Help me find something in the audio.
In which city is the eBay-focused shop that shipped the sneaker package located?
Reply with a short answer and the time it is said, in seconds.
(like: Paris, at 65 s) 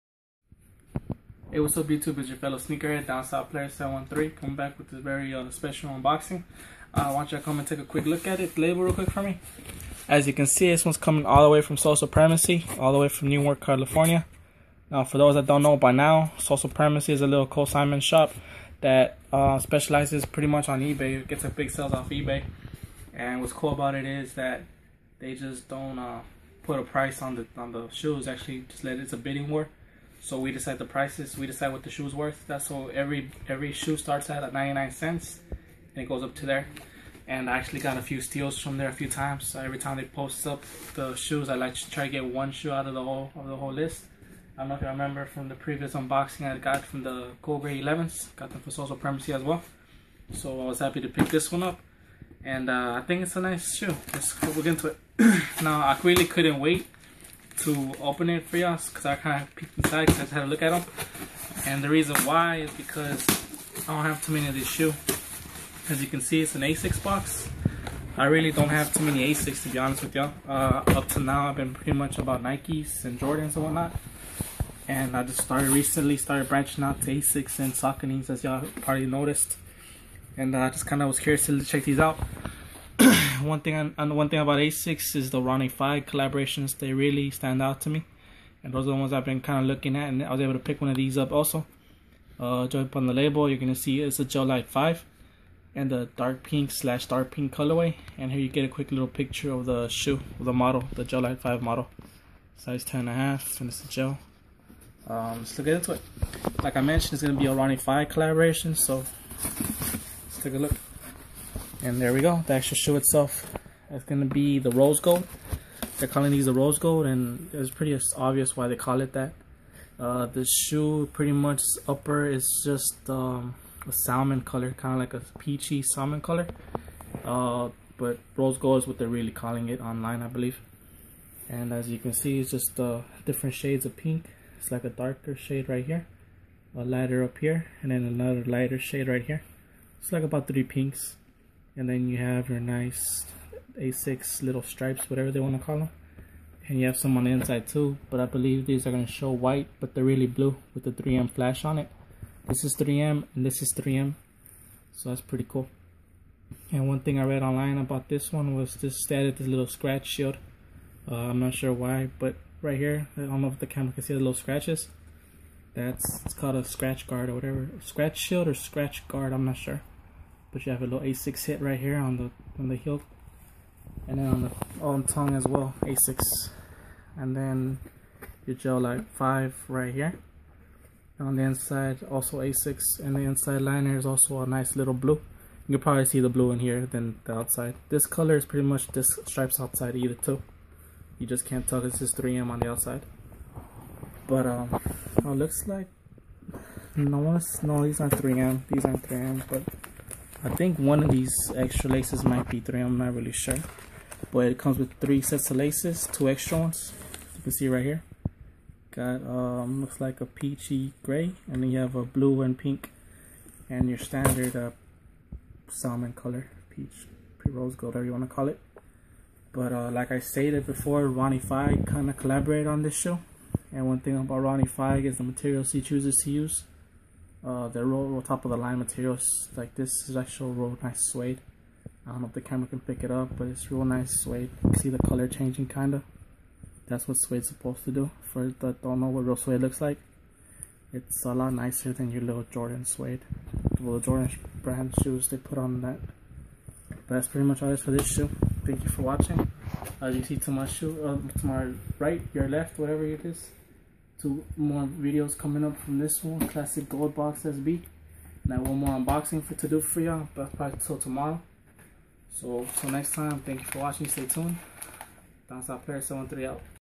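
Newark, California, at 13 s.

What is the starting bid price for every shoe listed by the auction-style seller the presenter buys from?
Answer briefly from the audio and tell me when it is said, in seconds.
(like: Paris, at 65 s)
99 cents, at 34 s.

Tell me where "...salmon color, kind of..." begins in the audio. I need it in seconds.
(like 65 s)
124 s.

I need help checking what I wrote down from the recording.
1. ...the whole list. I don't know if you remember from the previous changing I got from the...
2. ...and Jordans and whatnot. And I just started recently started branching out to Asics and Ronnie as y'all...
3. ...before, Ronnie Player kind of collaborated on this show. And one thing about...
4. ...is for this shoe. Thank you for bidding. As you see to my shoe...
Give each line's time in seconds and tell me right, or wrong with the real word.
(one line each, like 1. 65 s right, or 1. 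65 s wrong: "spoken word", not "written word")
1. 43 s wrong: "unboxing", not "changing"
2. 73 s wrong: "Sauconys", not "Ronnie"
3. 220 s wrong: "Fieg", not "Player"
4. 247 s wrong: "watching", not "bidding".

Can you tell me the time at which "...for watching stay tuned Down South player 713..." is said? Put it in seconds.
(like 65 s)
263 s.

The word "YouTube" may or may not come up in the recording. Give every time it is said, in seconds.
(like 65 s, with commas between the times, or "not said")
1 s.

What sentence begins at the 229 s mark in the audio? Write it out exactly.
Like this is actual real nice suede.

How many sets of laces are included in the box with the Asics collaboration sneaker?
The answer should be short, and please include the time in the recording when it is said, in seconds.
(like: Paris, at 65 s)
3, at 204 s.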